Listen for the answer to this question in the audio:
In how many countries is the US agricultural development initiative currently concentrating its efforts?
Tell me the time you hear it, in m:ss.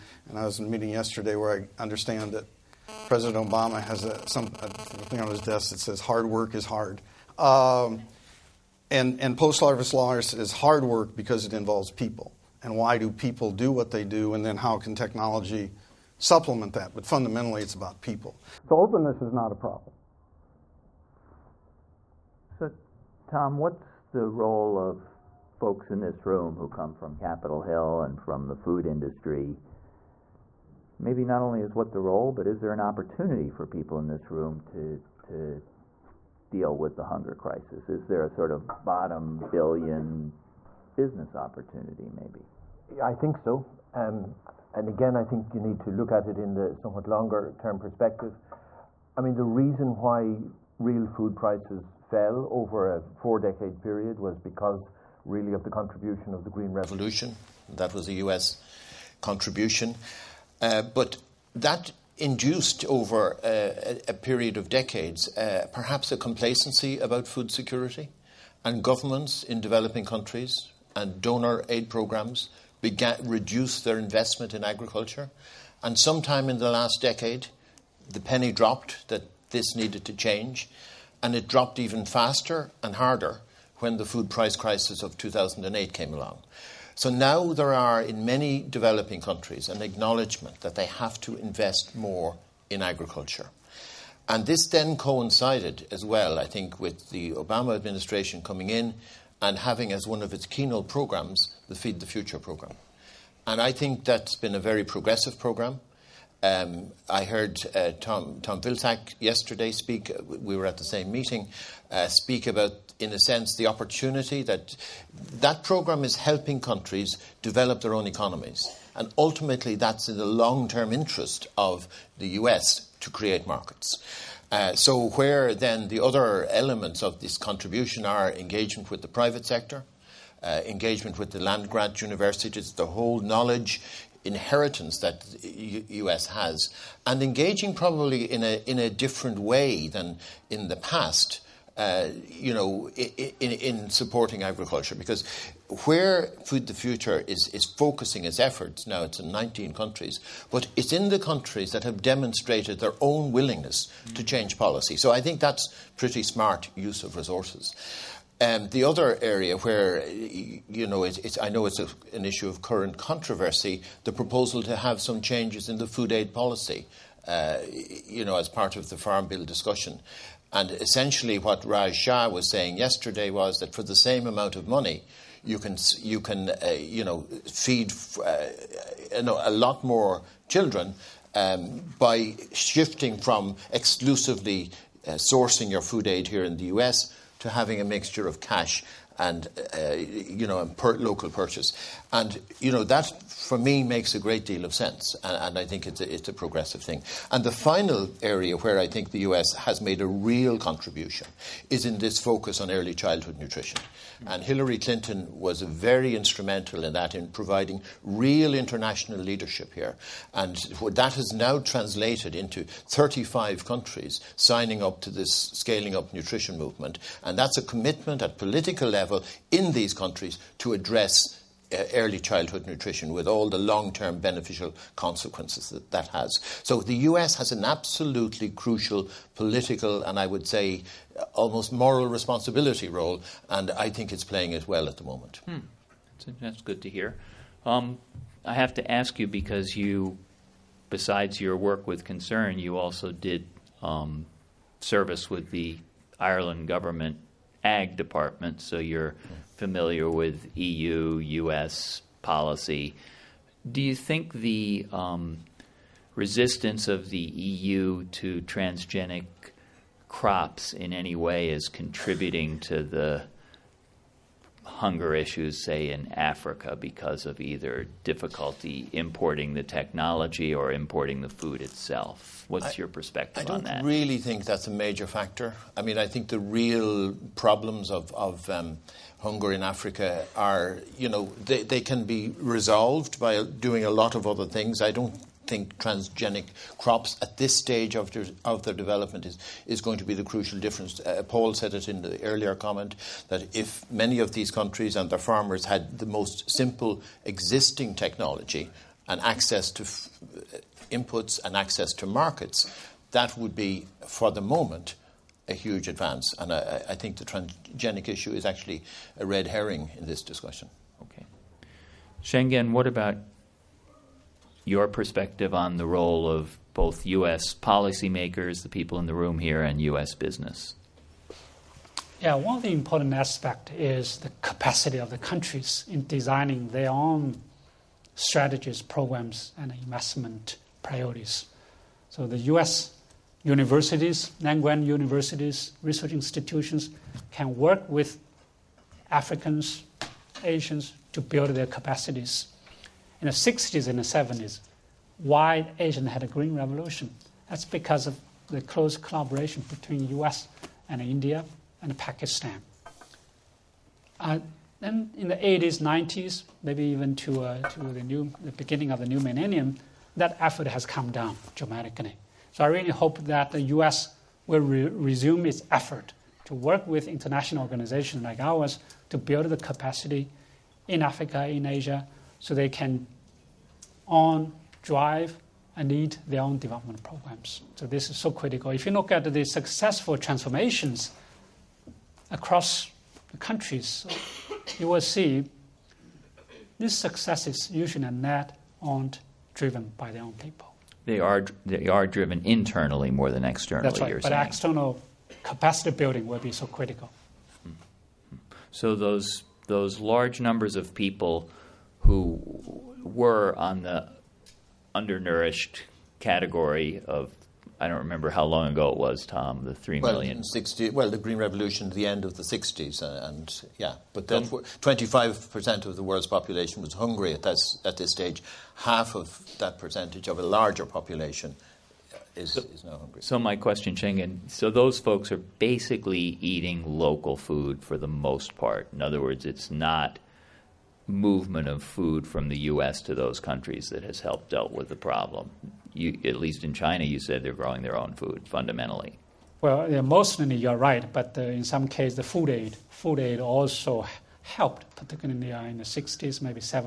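2:29.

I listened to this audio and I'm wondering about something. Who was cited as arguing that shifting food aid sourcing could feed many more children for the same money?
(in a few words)
Raj Shah.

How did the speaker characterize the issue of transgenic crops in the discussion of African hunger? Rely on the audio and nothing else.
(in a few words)
a red herring.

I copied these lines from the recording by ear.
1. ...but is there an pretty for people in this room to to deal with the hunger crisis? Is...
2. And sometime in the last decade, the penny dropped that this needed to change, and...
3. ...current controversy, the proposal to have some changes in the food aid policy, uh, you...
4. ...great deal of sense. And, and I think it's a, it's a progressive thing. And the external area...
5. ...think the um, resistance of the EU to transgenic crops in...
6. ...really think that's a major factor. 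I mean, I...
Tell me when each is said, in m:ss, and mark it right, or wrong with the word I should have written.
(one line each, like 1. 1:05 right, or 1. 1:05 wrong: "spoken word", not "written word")
1. 0:32 wrong: "opportunity", not "pretty"
2. 1:15 right
3. 2:42 right
4. 3:14 wrong: "final", not "external"
5. 4:13 right
6. 4:33 right.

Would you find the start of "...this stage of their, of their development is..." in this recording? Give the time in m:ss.
4:47.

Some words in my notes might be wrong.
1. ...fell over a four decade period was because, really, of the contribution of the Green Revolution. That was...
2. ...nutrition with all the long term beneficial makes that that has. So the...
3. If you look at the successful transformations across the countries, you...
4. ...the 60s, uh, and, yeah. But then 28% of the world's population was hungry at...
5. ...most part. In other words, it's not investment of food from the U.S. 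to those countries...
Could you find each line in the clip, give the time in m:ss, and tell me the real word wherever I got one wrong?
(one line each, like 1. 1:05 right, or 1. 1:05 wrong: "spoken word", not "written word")
1. 0:52 right
2. 3:42 wrong: "consequences", not "makes"
3. 6:18 right
4. 6:52 wrong: "25", not "28"
5. 7:08 wrong: "movement", not "investment".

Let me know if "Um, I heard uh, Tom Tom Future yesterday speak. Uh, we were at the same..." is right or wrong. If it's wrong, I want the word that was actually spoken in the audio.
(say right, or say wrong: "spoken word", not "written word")
wrong: "Vilsack", not "Future".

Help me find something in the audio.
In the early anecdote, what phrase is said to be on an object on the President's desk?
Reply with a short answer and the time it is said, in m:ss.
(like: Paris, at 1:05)
Hard work is hard, at 0:05.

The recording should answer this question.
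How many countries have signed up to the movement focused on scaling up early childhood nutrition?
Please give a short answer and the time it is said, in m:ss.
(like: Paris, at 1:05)
35, at 3:32.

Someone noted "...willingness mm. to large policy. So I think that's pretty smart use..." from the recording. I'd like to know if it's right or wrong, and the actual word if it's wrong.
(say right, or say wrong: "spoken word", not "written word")
wrong: "change", not "large".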